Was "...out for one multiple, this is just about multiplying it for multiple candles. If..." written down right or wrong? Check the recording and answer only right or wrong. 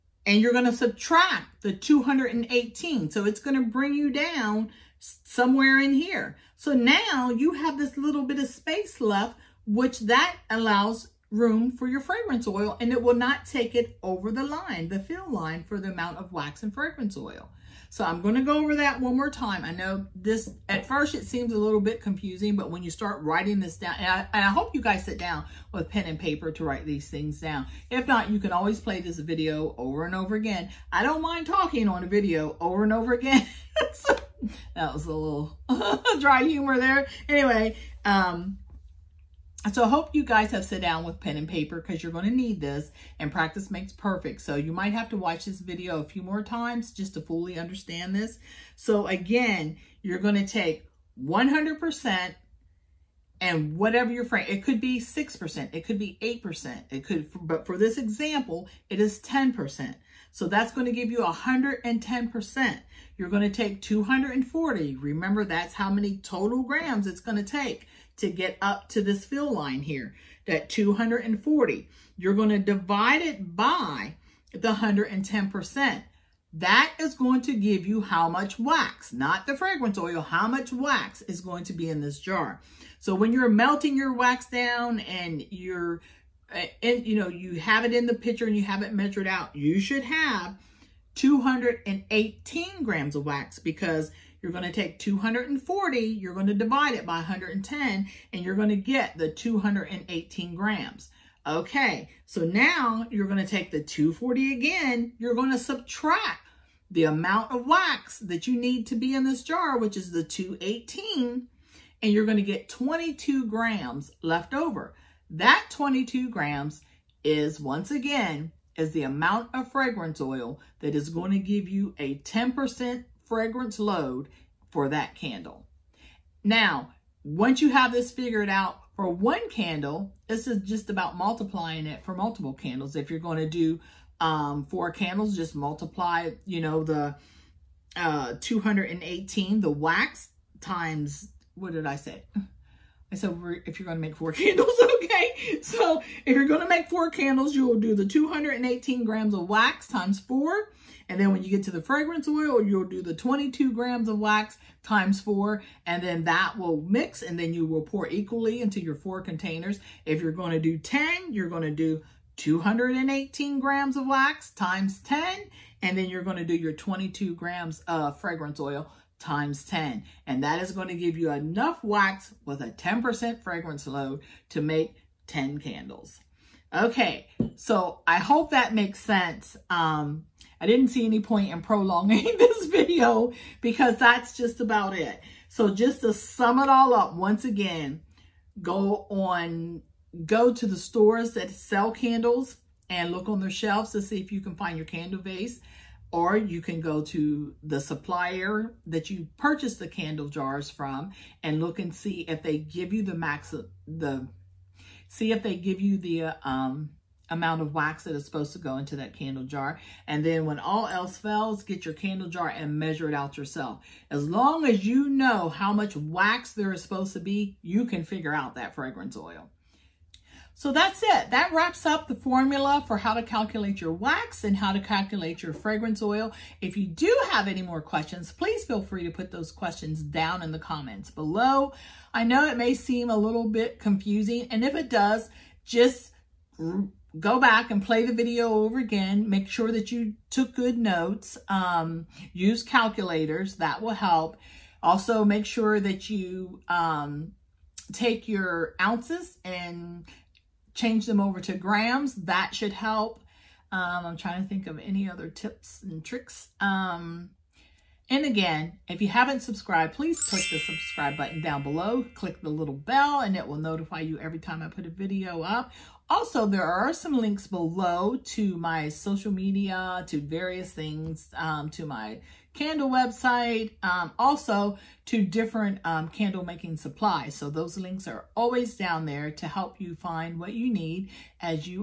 wrong.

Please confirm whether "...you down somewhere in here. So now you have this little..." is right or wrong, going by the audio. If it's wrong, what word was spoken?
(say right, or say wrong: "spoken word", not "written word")
right.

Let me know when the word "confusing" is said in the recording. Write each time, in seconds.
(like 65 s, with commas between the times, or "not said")
22 s, 233 s.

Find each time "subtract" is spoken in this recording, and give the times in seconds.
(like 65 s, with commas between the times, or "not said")
0 s, 105 s.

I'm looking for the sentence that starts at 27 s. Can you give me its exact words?
If not, you can always play this video over and over again.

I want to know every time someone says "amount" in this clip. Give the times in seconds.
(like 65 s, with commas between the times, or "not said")
15 s, 107 s, 119 s, 207 s.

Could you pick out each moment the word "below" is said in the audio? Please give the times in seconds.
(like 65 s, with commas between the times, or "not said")
231 s, 261 s, 267 s.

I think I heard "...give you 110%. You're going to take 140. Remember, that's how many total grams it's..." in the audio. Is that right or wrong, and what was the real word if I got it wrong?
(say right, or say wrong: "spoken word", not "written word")
wrong: "240", not "140".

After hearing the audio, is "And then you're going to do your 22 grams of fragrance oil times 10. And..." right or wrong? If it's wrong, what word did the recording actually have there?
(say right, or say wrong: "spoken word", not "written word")
right.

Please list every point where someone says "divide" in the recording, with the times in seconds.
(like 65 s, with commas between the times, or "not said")
72 s, 96 s.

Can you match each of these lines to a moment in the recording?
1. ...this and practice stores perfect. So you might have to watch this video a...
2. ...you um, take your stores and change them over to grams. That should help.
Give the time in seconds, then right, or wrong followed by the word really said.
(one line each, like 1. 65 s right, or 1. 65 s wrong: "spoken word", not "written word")
1. 42 s wrong: "makes", not "stores"
2. 246 s wrong: "ounces", not "stores".